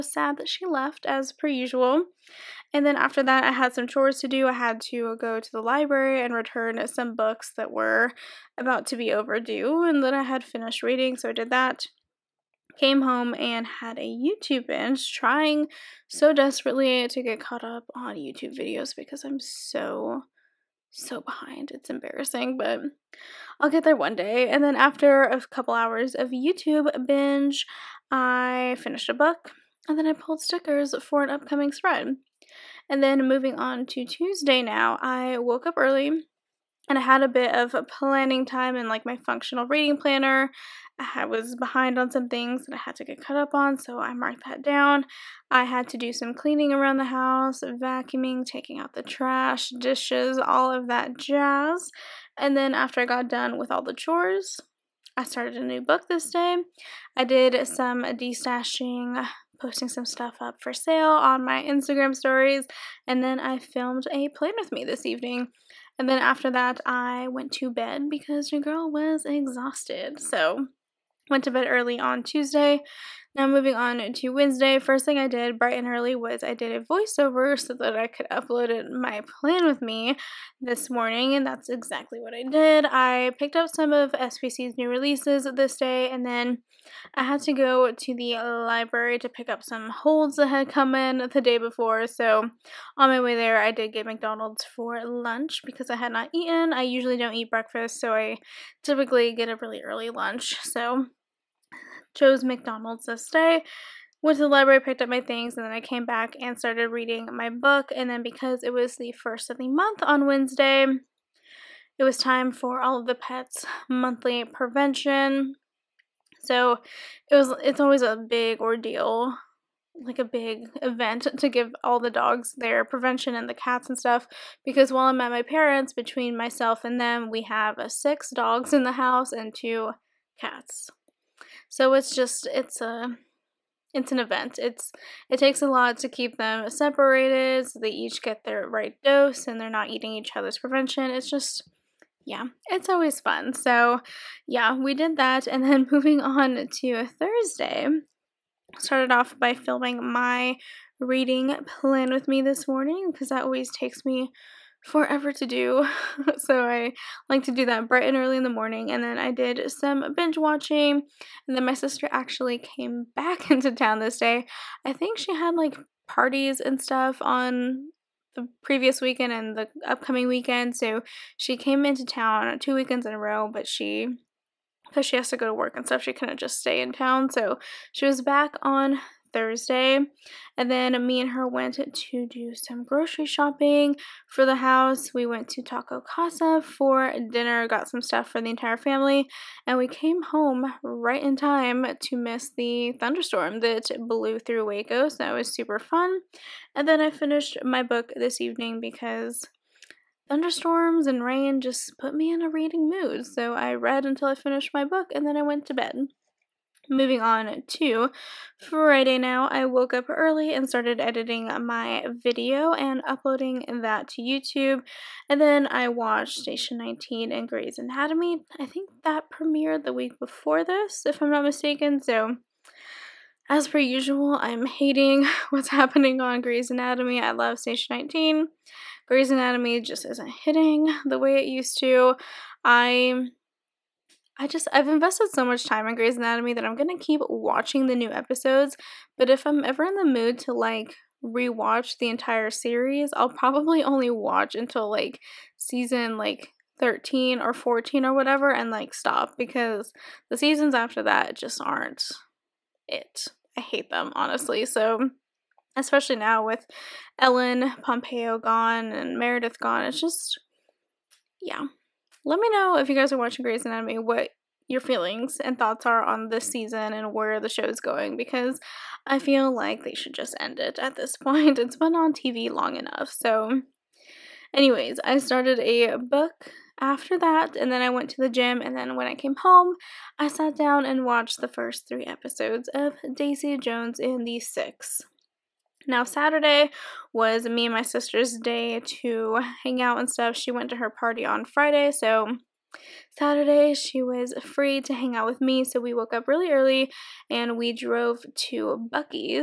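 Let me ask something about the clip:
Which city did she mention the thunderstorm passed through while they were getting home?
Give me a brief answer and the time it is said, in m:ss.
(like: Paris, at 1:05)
Waco, at 3:14.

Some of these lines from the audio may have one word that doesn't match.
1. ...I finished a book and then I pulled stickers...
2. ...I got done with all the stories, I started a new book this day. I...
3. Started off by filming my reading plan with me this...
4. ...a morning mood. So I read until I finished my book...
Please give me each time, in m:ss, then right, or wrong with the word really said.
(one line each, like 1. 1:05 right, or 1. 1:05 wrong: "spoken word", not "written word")
1. 0:28 right
2. 0:53 wrong: "chores", not "stories"
3. 2:28 right
4. 3:22 wrong: "reading", not "morning".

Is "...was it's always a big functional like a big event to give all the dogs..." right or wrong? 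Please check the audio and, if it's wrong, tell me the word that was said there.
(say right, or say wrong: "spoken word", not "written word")
wrong: "ordeal", not "functional".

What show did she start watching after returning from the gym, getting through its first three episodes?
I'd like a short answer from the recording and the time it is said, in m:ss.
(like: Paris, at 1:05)
Daisy Jones and the Six, at 4:43.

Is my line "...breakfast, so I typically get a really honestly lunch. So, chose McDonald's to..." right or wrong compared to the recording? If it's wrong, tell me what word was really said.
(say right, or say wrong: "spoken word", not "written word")
wrong: "early", not "honestly".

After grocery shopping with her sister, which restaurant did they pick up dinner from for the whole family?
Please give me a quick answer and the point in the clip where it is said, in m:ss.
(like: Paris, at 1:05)
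Taco Casa, at 3:05.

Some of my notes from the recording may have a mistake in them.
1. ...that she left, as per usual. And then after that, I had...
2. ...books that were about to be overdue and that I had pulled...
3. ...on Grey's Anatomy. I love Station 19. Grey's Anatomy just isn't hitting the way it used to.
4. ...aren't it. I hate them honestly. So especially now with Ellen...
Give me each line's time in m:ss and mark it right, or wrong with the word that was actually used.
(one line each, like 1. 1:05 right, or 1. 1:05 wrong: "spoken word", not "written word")
1. 0:00 right
2. 0:07 wrong: "finished", not "pulled"
3. 3:46 right
4. 4:11 right.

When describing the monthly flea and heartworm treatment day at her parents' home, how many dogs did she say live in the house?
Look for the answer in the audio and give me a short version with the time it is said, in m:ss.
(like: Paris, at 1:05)
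6, at 2:07.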